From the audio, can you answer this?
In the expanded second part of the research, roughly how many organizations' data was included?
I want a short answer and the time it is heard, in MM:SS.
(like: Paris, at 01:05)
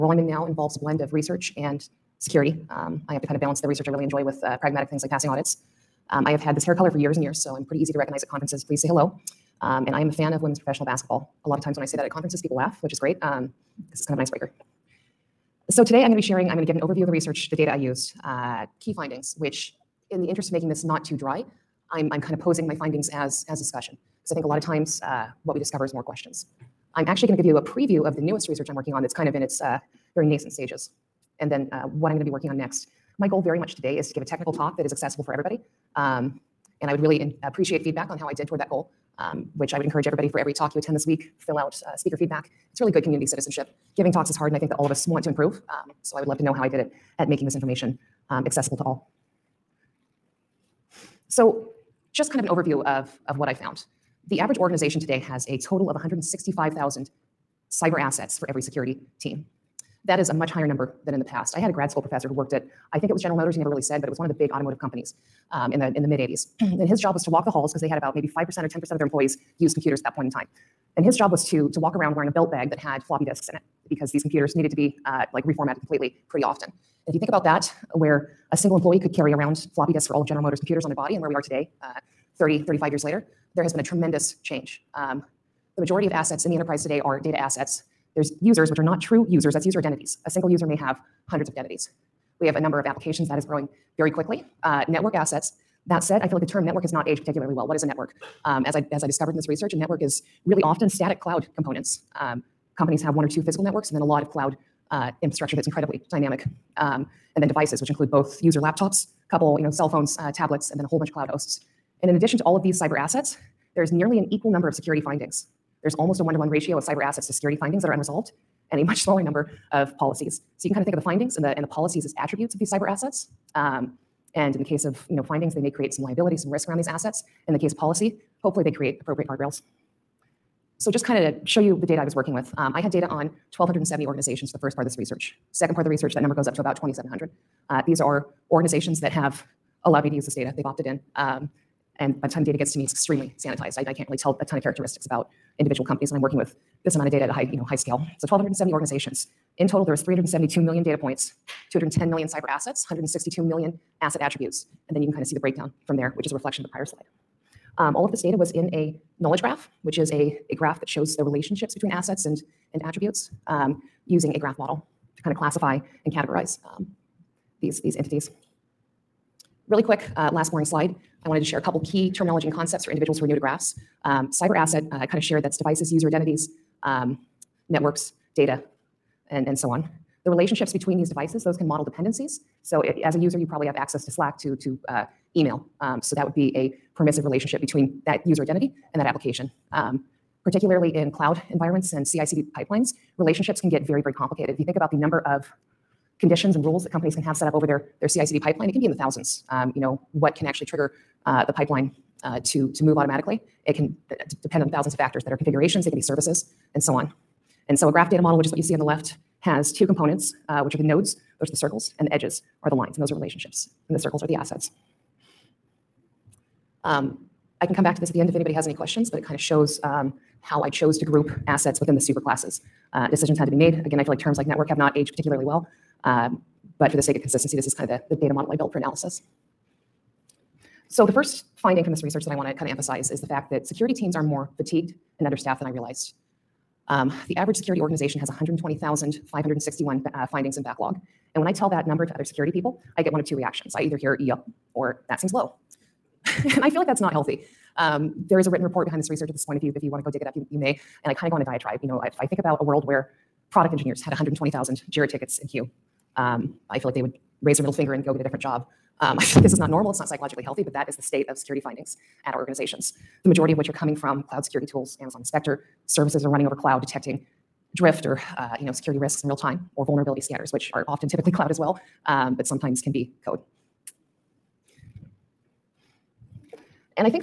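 2,700, at 02:16.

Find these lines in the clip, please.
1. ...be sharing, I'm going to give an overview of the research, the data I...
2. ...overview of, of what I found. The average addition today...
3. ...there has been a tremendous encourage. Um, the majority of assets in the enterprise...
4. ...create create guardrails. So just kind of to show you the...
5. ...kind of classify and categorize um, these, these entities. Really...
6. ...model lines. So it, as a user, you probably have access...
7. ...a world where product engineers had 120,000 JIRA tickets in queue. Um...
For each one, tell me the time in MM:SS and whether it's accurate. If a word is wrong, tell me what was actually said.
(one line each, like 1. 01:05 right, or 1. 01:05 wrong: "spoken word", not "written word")
1. 00:16 right
2. 00:52 wrong: "organization", not "addition"
3. 01:23 wrong: "change", not "encourage"
4. 02:08 wrong: "appropriate", not "create"
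5. 02:45 right
6. 03:01 wrong: "dependencies", not "lines"
7. 04:12 right.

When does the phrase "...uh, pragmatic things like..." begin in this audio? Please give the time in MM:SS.
00:04.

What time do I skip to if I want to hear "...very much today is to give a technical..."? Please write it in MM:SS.
00:33.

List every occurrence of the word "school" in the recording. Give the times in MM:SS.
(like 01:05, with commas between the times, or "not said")
01:01.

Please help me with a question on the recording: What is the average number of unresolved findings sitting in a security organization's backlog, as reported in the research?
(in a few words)
120,561.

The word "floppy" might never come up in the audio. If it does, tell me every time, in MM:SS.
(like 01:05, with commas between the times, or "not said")
01:13, 01:19.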